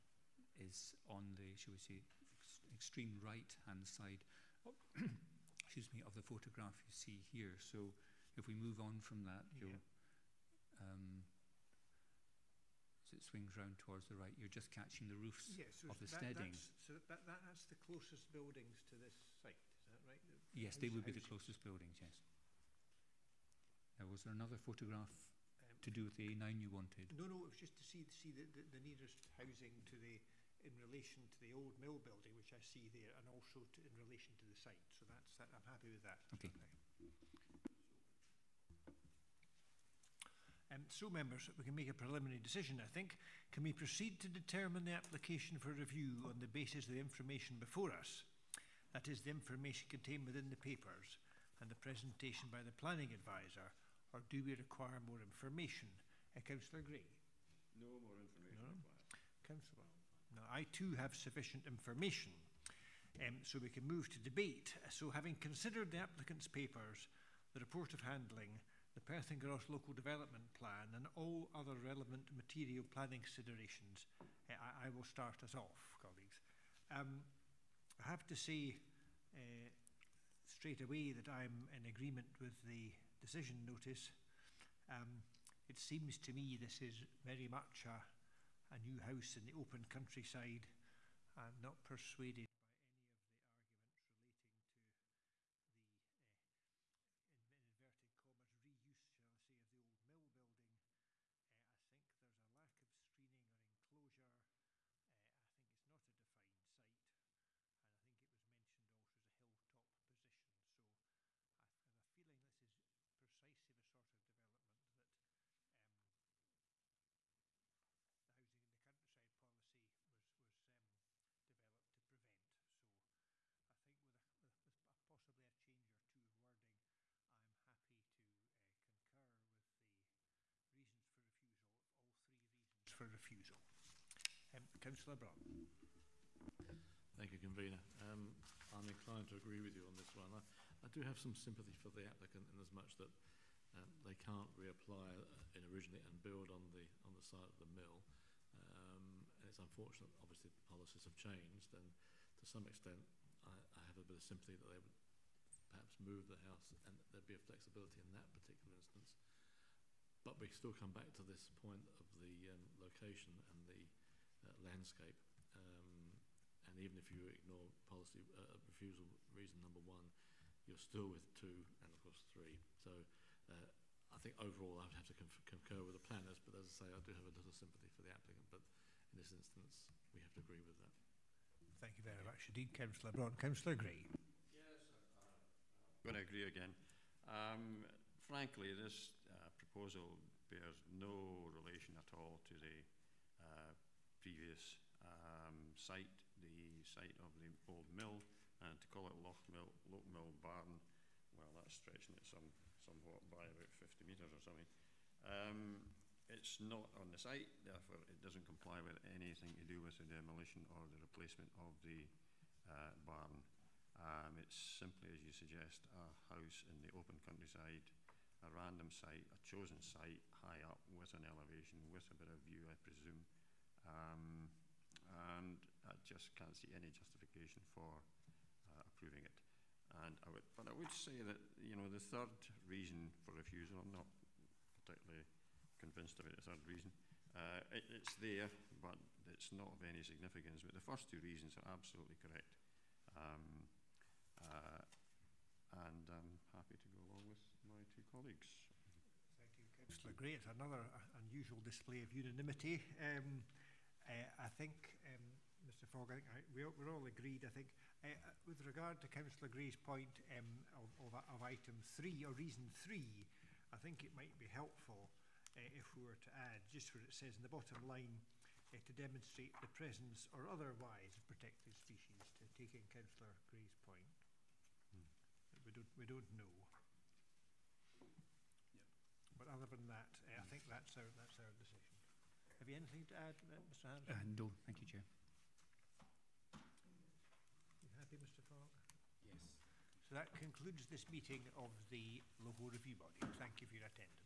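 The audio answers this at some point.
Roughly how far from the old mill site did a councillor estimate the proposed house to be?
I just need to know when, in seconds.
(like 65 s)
203 s.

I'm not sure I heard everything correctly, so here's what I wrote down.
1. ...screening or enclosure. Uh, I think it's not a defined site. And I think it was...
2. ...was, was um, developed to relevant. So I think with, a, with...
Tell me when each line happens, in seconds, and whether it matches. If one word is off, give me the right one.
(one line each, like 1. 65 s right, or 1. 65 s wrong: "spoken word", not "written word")
1. 102 s right
2. 120 s wrong: "prevent", not "relevant".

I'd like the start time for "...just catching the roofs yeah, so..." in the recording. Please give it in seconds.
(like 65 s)
14 s.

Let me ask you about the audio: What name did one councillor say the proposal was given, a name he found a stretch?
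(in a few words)
Loch Mill Barn.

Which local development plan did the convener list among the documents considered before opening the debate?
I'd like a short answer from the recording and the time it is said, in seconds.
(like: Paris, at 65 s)
Perth and Kinross Local Development Plan, at 69 s.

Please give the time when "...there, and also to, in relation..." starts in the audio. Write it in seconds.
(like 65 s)
32 s.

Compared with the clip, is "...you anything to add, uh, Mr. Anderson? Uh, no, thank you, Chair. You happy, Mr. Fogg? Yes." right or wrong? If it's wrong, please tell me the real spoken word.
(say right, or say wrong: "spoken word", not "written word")
right.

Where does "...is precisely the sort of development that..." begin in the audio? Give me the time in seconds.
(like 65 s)
112 s.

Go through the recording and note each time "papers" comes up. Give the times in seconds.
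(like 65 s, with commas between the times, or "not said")
50 s, 66 s.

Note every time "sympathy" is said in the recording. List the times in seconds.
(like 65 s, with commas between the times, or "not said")
141 s, 154 s, 177 s.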